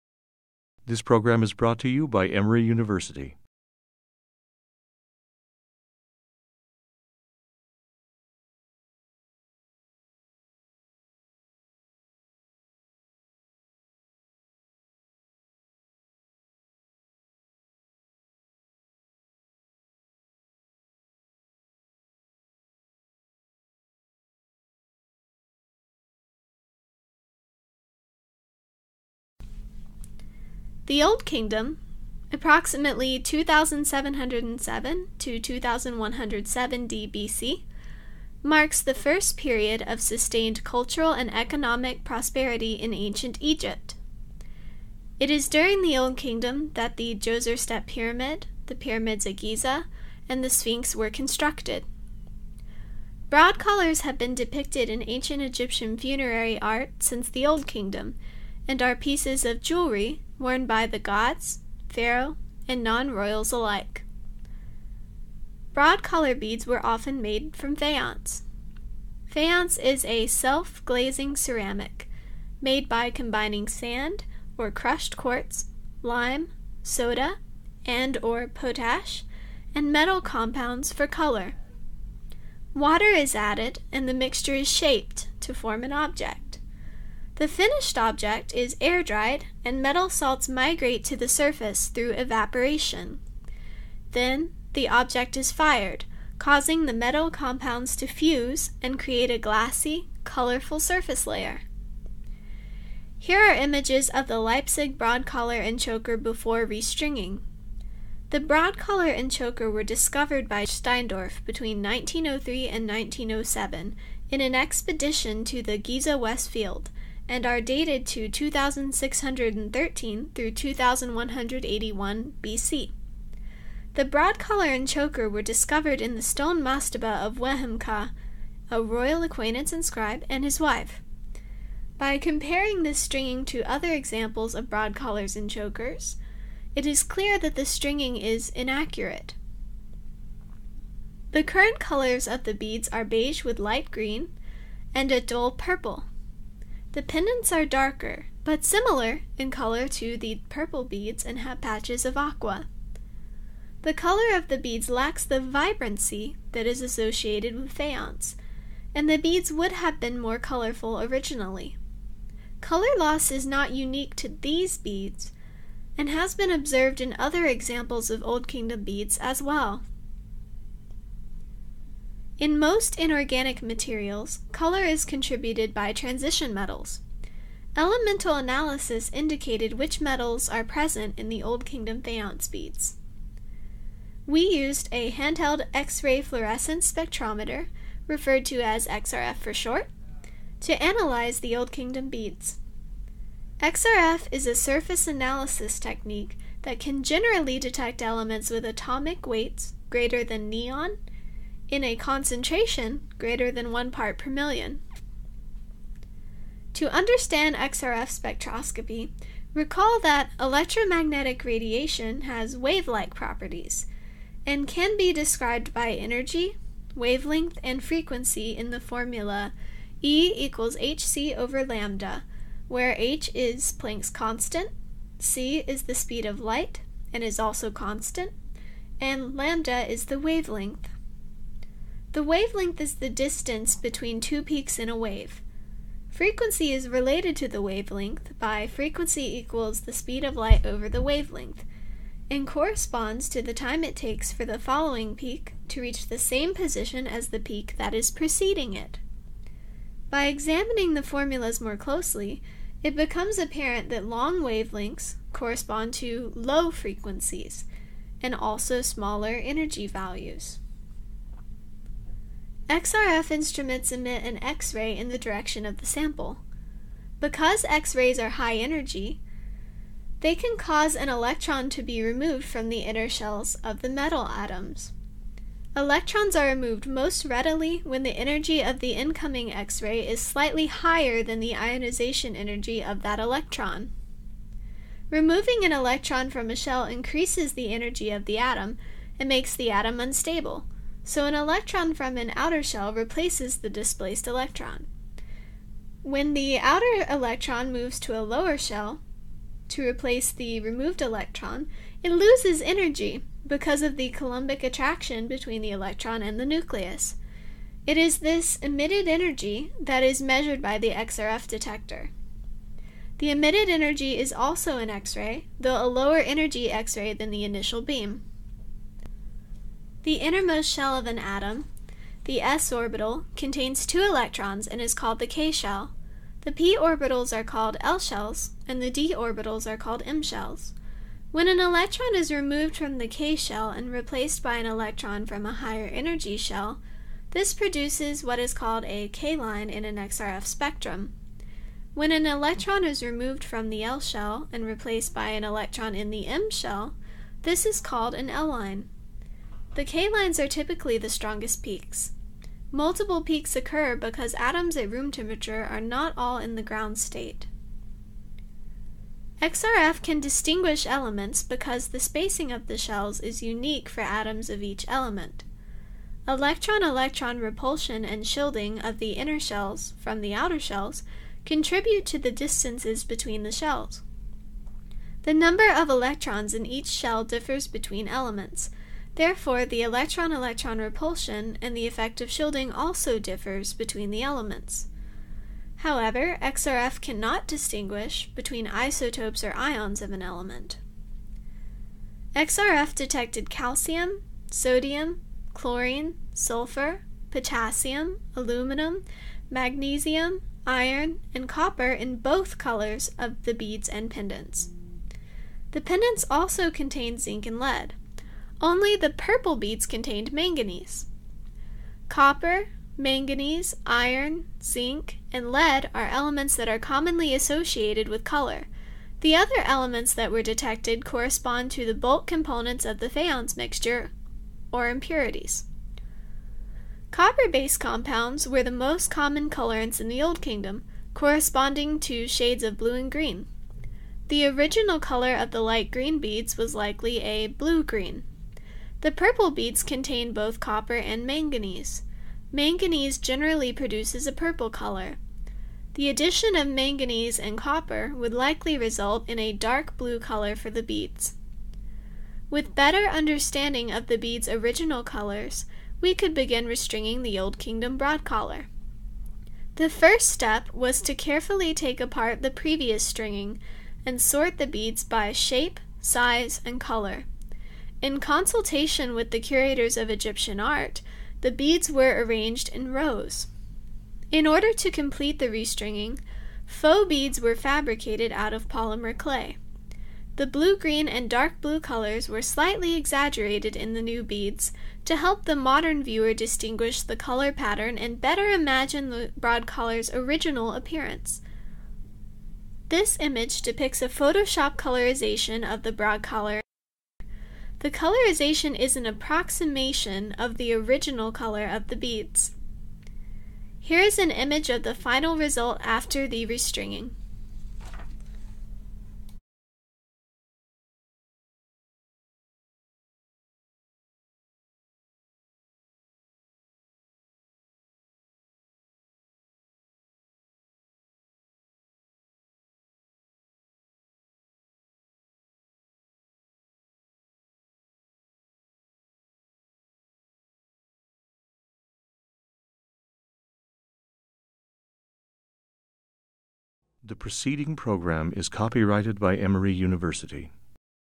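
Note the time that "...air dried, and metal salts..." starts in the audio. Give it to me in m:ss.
1:28.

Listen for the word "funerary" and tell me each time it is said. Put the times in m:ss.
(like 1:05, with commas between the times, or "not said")
0:55.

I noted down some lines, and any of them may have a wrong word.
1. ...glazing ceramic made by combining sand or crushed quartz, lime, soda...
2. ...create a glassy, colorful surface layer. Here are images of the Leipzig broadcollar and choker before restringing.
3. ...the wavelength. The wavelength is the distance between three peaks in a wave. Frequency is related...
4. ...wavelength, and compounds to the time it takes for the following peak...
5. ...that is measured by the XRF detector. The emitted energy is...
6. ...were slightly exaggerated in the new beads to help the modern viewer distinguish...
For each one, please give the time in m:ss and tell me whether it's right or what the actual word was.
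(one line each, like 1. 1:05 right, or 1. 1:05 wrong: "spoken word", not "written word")
1. 1:10 right
2. 1:38 right
3. 3:50 wrong: "two", not "three"
4. 4:01 wrong: "corresponds", not "compounds"
5. 5:09 right
6. 8:02 right.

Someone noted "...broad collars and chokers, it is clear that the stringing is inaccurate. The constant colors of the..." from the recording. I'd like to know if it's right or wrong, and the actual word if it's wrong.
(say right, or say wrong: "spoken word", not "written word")
wrong: "current", not "constant".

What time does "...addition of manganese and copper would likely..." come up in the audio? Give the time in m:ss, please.
7:26.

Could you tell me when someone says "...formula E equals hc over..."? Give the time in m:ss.
3:38.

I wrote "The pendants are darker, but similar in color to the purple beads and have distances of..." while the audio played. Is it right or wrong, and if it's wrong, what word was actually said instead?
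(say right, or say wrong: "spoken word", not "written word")
wrong: "patches", not "distances".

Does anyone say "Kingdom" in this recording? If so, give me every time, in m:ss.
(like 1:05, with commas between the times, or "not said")
0:31, 0:46, 0:57, 2:48, 3:01, 3:11, 7:10, 7:37.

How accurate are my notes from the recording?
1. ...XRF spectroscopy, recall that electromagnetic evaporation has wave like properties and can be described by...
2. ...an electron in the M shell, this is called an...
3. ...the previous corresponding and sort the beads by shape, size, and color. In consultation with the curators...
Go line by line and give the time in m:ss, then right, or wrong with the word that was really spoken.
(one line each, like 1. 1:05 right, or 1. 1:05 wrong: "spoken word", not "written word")
1. 3:27 wrong: "radiation", not "evaporation"
2. 5:45 right
3. 7:42 wrong: "stringing", not "corresponding".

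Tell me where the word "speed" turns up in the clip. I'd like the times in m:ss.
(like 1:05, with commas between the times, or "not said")
3:45, 3:59.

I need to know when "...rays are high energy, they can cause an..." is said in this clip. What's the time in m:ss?
4:27.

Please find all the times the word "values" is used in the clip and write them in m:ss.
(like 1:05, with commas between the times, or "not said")
4:19.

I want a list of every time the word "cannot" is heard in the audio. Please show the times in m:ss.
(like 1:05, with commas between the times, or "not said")
6:27.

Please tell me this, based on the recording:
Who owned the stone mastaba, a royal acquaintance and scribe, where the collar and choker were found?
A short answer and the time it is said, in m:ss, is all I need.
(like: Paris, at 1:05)
Wehemka, at 2:07.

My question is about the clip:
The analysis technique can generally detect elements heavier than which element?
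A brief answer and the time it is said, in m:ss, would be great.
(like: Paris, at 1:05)
Neon, at 3:20.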